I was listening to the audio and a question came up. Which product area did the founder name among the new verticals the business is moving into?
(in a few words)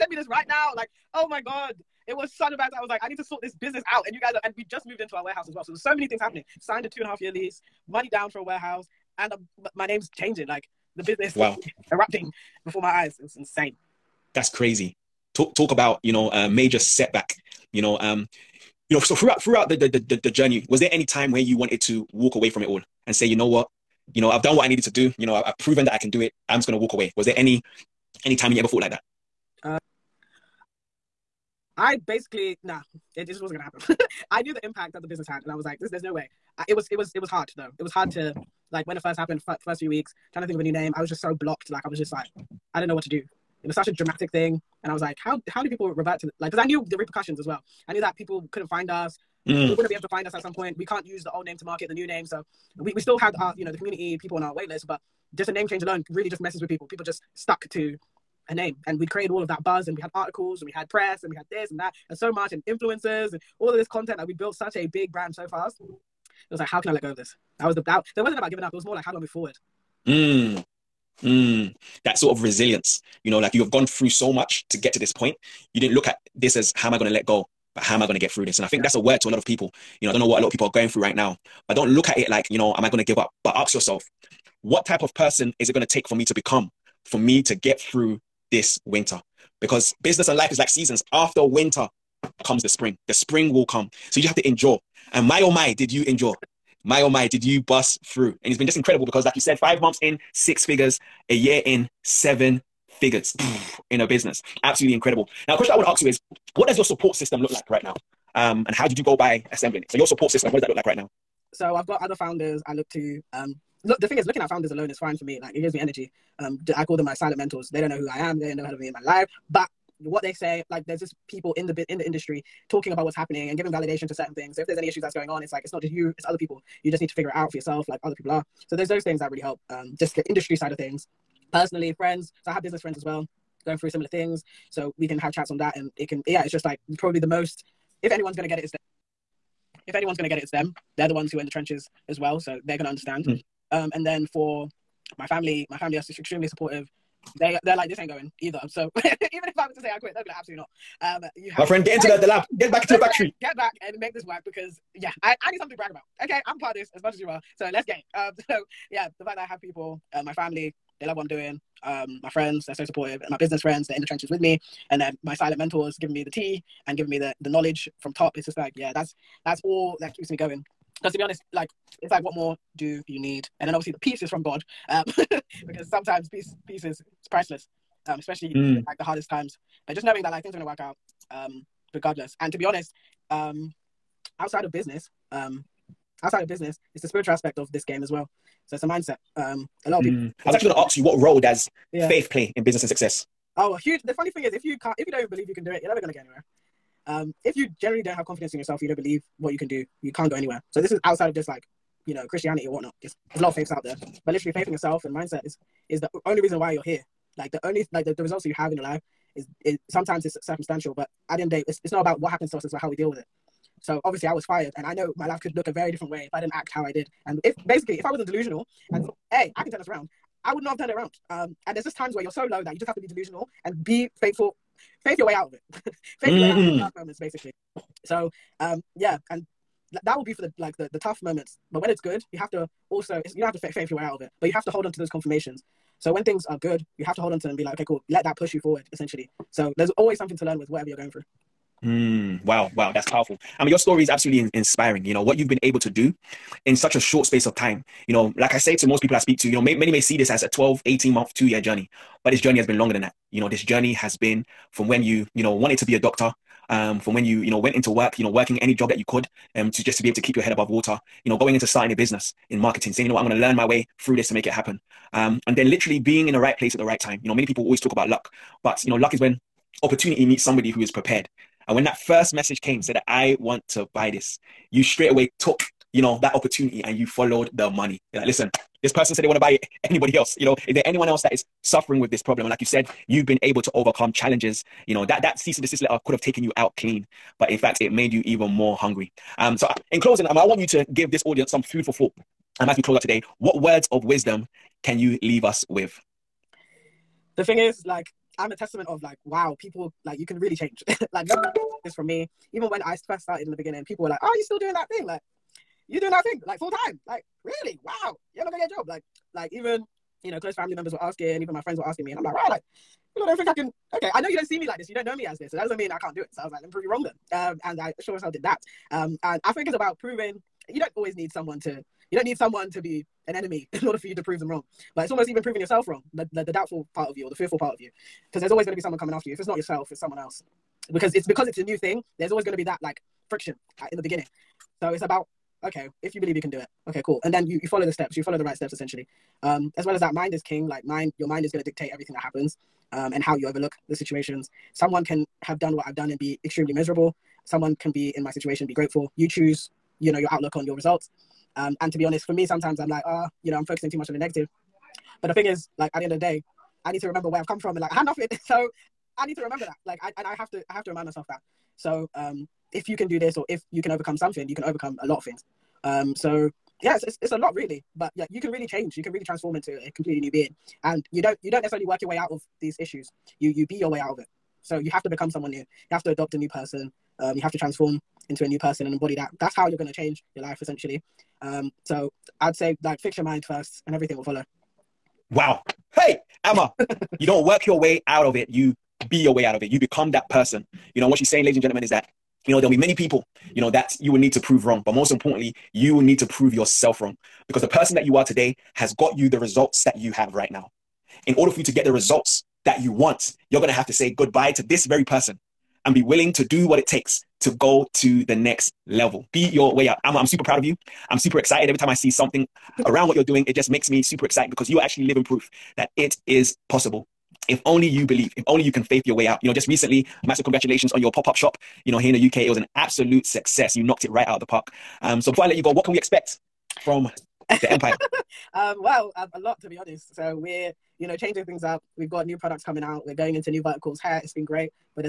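Hair.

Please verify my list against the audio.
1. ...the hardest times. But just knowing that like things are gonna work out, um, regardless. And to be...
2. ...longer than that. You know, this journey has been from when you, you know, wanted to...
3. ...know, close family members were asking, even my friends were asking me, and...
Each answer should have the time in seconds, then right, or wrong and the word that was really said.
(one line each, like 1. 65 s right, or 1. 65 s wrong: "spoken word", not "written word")
1. 178 s right
2. 252 s right
3. 310 s right.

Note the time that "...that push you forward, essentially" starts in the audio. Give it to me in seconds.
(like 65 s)
238 s.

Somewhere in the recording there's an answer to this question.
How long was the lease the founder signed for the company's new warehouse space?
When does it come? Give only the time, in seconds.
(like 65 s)
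6 s.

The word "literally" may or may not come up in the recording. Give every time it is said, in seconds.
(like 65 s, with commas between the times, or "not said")
204 s, 265 s.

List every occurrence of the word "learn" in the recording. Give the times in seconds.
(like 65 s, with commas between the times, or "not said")
240 s, 263 s.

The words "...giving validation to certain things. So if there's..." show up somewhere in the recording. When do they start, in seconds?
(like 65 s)
123 s.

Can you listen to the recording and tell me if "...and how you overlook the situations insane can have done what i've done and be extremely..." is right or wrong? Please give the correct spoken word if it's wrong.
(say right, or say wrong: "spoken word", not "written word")
wrong: "someone", not "insane".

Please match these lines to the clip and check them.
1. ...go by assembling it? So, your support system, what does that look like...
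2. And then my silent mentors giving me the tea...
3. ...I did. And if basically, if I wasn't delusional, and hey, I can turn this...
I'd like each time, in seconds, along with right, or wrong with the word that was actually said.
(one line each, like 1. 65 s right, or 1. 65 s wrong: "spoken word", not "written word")
1. 109 s right
2. 164 s right
3. 216 s right.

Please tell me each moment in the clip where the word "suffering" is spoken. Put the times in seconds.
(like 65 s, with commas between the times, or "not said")
281 s.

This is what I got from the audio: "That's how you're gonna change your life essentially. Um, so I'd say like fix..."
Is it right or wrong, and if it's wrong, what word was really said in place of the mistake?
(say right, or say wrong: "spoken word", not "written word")
right.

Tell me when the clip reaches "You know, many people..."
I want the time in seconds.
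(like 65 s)
267 s.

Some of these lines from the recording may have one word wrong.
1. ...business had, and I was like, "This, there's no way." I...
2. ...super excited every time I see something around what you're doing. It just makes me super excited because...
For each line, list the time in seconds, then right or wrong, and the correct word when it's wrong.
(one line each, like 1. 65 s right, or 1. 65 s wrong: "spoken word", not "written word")
1. 35 s right
2. 411 s right.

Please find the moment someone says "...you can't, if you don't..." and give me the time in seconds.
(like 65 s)
194 s.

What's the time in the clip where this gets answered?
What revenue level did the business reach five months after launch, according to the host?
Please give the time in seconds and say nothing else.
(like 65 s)
100 s.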